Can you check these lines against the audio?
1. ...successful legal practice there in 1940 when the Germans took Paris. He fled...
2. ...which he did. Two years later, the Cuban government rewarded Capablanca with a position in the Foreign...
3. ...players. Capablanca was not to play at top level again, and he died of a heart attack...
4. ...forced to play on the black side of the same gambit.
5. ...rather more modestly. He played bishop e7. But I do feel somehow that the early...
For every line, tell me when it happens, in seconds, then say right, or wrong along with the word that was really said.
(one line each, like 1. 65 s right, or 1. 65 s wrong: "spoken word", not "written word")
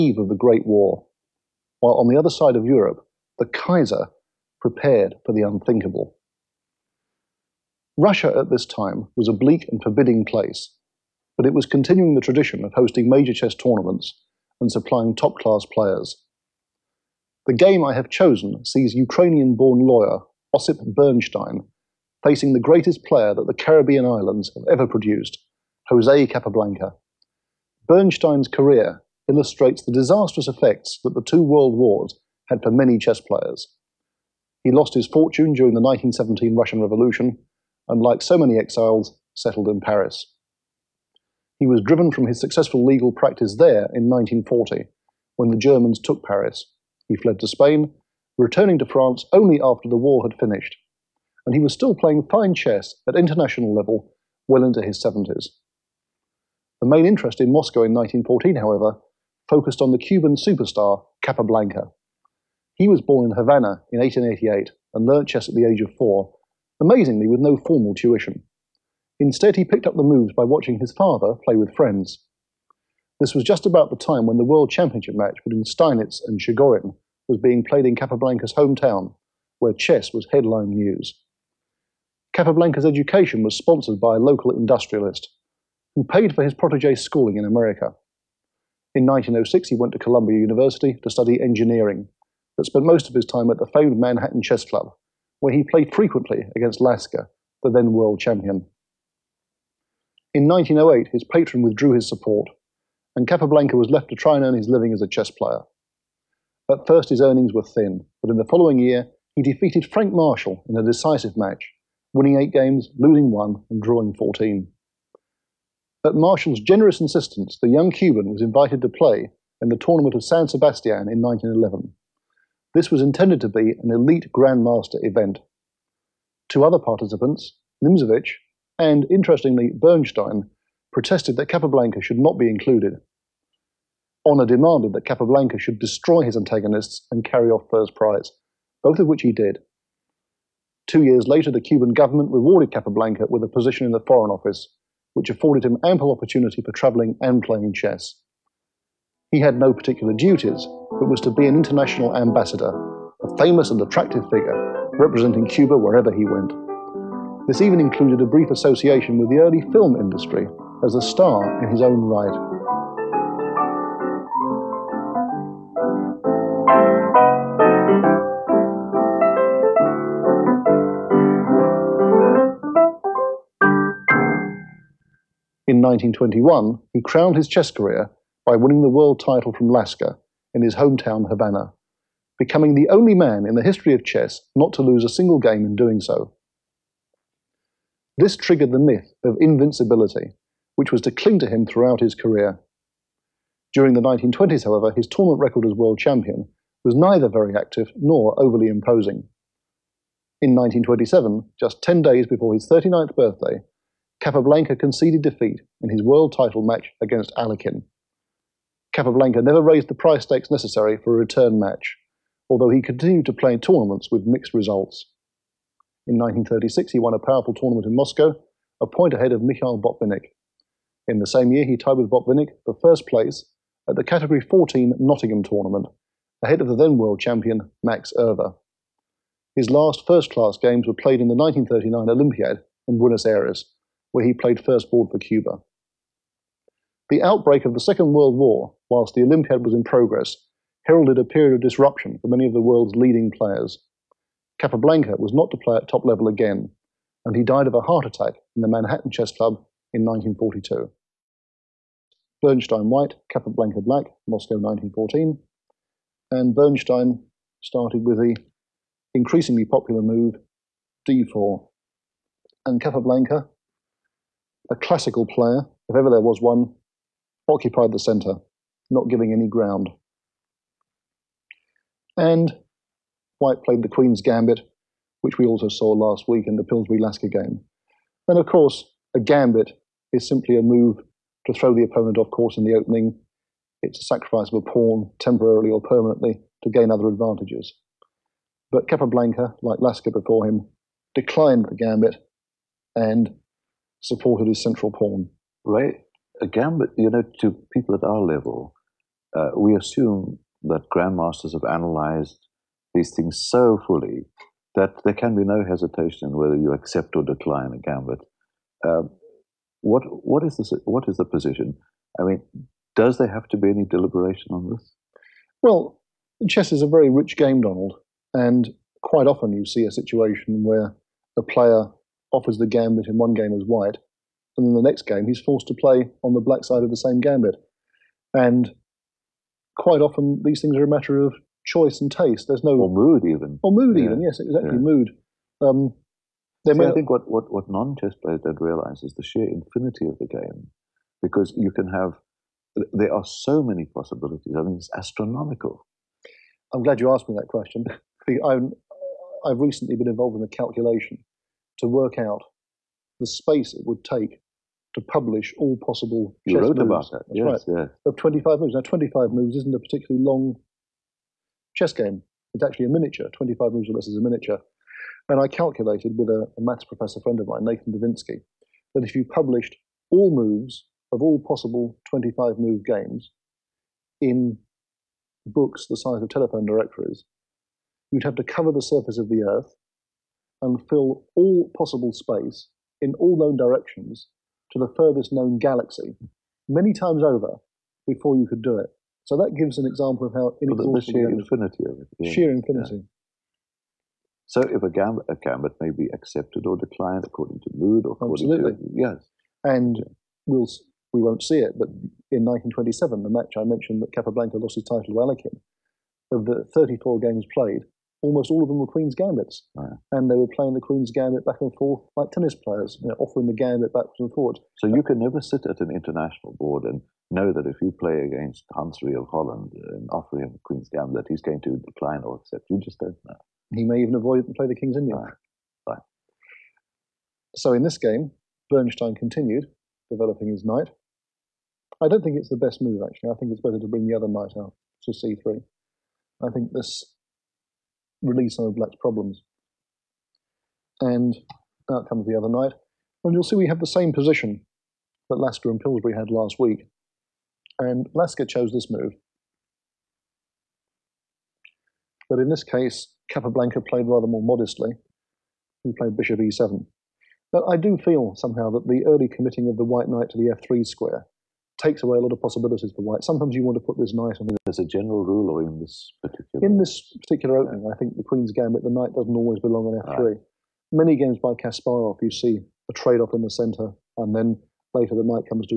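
1. 42 s right
2. 139 s right
3. 243 s right
4. 325 s right
5. 454 s right.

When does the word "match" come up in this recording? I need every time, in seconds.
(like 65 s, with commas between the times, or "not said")
75 s, 111 s, 206 s, 211 s, 403 s.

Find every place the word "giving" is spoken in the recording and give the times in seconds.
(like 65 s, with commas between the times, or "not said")
269 s.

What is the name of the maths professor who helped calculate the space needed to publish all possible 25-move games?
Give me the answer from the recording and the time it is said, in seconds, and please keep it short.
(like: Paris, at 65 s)
Nathan Divinsky, at 367 s.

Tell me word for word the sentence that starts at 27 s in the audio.
Bernstein's career illustrates the disastrous effects that the two world wars had for many chess players.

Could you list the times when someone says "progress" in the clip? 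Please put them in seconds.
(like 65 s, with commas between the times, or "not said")
239 s.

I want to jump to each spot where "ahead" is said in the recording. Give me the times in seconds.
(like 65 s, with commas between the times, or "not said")
219 s, 226 s.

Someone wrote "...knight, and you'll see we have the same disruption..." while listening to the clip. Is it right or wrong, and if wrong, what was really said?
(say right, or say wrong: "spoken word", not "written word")
wrong: "position", not "disruption".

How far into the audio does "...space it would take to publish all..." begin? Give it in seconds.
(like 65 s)
353 s.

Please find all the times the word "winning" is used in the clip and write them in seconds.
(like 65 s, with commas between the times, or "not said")
112 s, 178 s.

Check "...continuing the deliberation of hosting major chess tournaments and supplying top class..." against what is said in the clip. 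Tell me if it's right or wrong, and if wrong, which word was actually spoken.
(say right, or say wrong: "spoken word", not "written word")
wrong: "tradition", not "deliberation".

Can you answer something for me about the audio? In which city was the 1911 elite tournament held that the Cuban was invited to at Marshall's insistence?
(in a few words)
San Sebastian.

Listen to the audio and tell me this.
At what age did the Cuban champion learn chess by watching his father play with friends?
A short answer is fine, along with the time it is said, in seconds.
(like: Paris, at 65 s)
4, at 65 s.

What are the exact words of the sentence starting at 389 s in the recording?
So that gives an example of how inexhaustible the sheer infinity of it.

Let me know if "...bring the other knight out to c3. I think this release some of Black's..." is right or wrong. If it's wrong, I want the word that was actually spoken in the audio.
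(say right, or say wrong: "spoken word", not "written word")
right.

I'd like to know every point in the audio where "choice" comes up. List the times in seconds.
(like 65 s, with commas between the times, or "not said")
331 s.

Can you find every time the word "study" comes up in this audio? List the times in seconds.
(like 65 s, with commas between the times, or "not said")
91 s.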